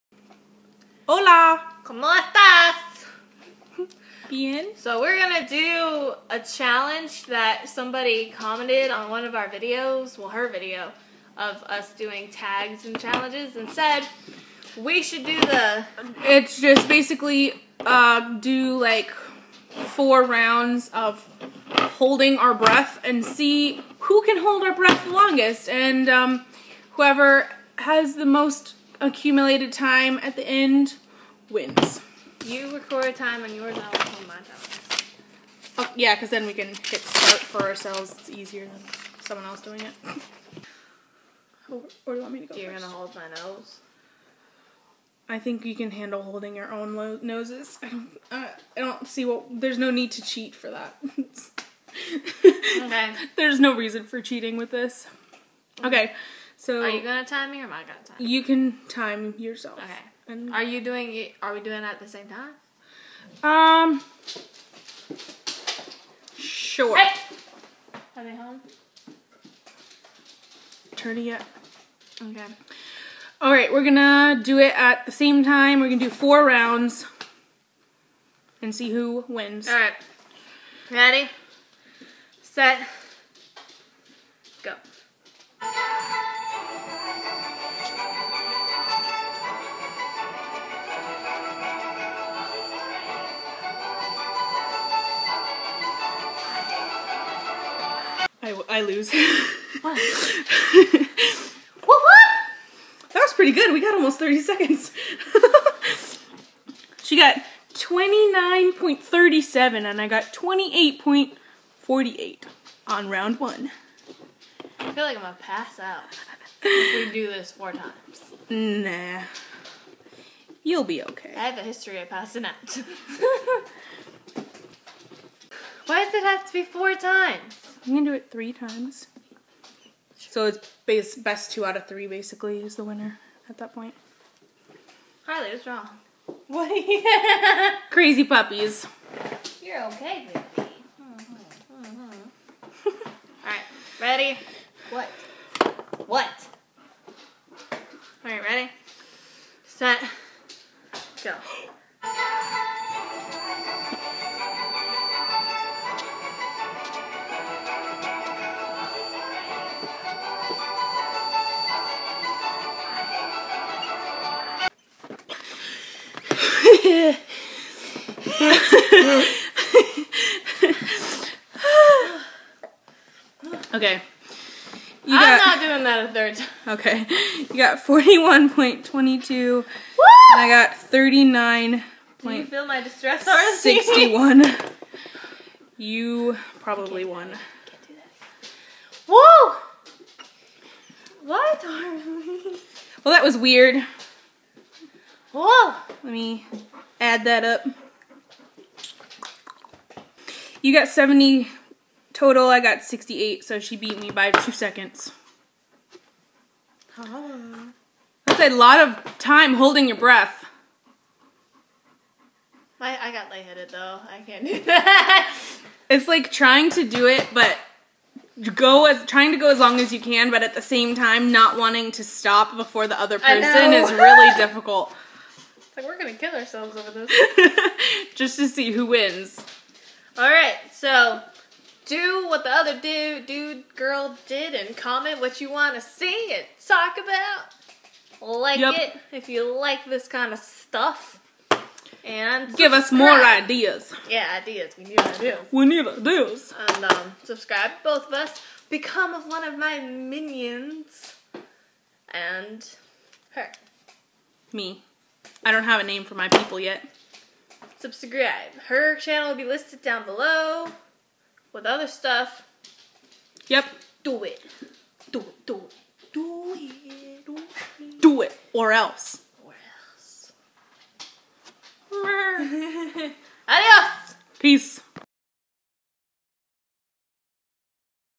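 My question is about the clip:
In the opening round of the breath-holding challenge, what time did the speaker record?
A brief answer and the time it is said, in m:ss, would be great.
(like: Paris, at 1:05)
28.48, at 1:50.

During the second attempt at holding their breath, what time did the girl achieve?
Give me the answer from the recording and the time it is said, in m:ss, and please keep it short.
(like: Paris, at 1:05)
41.22, at 2:57.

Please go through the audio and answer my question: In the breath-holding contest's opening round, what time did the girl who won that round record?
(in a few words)
29.37.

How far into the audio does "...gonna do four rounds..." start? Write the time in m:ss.
1:15.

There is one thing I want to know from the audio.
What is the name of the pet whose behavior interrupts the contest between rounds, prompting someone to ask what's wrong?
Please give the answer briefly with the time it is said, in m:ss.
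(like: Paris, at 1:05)
Kylie, at 2:15.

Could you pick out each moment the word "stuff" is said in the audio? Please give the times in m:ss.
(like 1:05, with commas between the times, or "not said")
4:00, 4:21.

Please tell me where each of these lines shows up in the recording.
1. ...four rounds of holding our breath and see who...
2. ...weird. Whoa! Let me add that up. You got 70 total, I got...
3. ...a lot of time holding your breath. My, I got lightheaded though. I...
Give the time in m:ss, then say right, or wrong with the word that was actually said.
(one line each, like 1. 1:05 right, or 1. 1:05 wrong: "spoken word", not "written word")
1. 0:19 right
2. 3:13 right
3. 3:28 right.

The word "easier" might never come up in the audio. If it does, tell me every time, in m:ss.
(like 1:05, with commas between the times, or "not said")
0:38.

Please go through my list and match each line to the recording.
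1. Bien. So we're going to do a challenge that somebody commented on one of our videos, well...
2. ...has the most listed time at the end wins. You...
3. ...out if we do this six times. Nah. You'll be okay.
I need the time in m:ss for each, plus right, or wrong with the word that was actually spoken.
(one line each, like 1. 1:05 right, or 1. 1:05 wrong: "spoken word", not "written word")
1. 0:04 right
2. 0:27 wrong: "accumulated", not "listed"
3. 1:55 wrong: "four", not "six".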